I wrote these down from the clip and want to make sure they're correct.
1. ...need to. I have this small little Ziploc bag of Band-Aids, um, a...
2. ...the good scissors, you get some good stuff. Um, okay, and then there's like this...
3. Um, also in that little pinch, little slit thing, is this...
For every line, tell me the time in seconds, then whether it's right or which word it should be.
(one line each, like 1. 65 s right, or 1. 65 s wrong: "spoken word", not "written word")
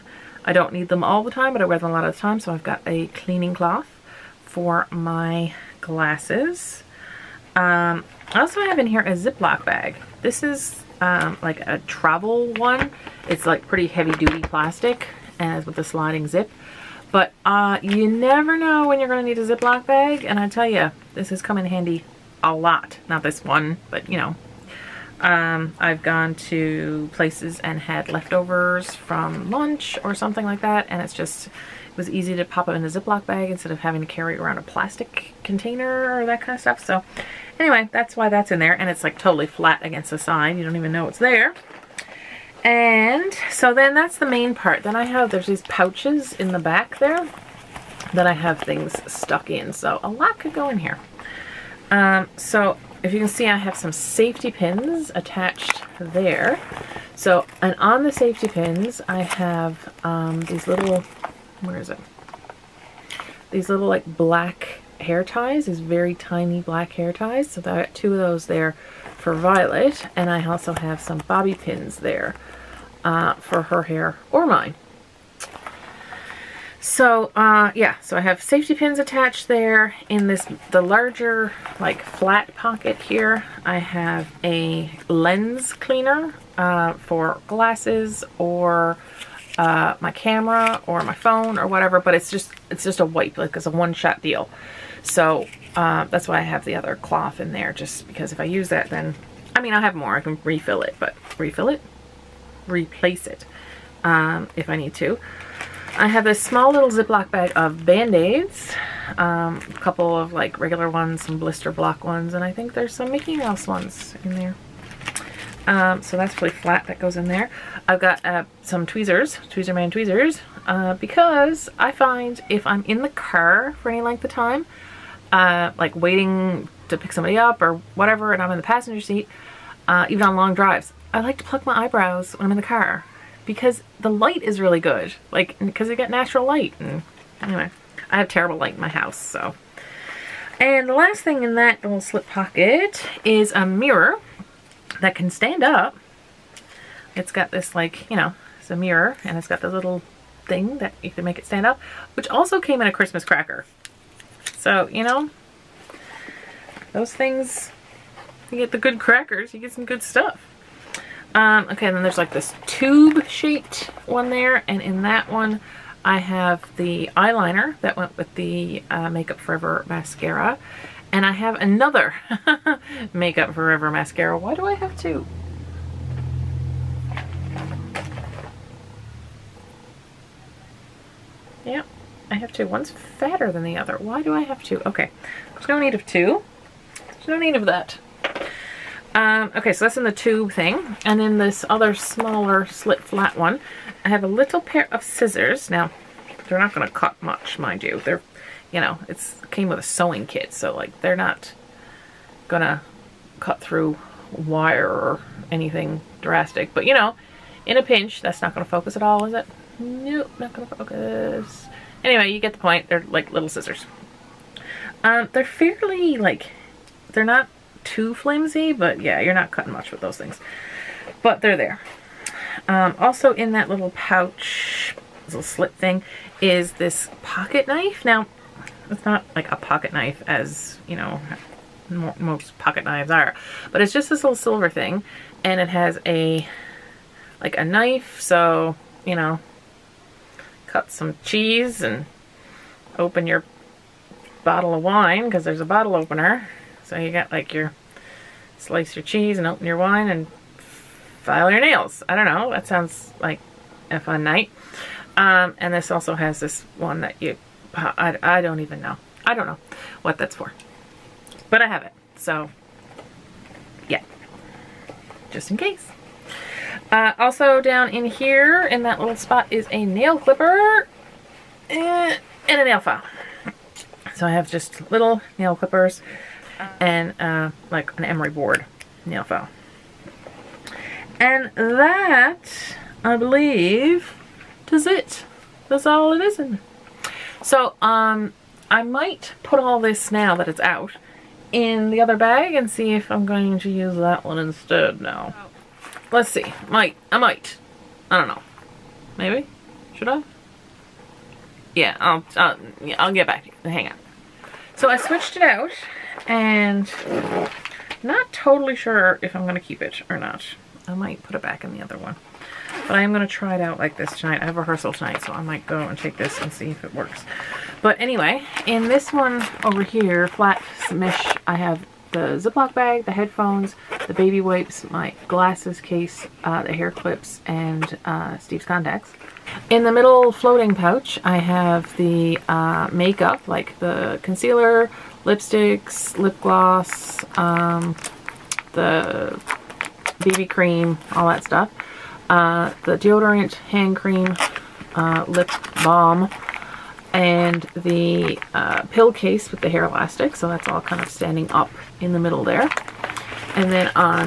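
1. 104 s right
2. 158 s wrong: "crackers", not "scissors"
3. 222 s wrong: "pouch", not "pinch".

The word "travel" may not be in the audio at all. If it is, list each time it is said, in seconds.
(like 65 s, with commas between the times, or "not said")
11 s.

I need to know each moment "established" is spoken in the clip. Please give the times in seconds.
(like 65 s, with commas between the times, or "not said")
not said.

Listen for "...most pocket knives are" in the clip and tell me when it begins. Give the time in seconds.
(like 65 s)
231 s.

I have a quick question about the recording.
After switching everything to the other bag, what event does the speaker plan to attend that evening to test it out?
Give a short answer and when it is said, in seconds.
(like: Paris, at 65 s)
Rehearsal, at 314 s.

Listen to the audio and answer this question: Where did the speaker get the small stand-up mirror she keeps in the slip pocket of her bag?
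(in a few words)
A Christmas cracker.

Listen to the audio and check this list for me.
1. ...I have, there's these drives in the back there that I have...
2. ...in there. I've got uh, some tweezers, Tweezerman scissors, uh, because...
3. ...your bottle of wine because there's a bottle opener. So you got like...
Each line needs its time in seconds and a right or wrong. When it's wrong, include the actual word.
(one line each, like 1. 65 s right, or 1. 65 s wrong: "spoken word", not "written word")
1. 44 s wrong: "pouches", not "drives"
2. 117 s wrong: "tweezers", not "scissors"
3. 243 s right.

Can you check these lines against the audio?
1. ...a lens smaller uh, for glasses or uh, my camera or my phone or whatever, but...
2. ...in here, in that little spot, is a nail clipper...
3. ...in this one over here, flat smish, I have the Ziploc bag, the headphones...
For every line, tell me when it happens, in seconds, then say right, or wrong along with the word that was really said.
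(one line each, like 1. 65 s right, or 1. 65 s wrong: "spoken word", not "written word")
1. 84 s wrong: "cleaner", not "smaller"
2. 267 s right
3. 318 s right.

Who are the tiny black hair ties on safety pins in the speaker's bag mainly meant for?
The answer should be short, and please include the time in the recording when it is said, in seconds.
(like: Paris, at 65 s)
Violet, at 69 s.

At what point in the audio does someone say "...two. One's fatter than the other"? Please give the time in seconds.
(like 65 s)
182 s.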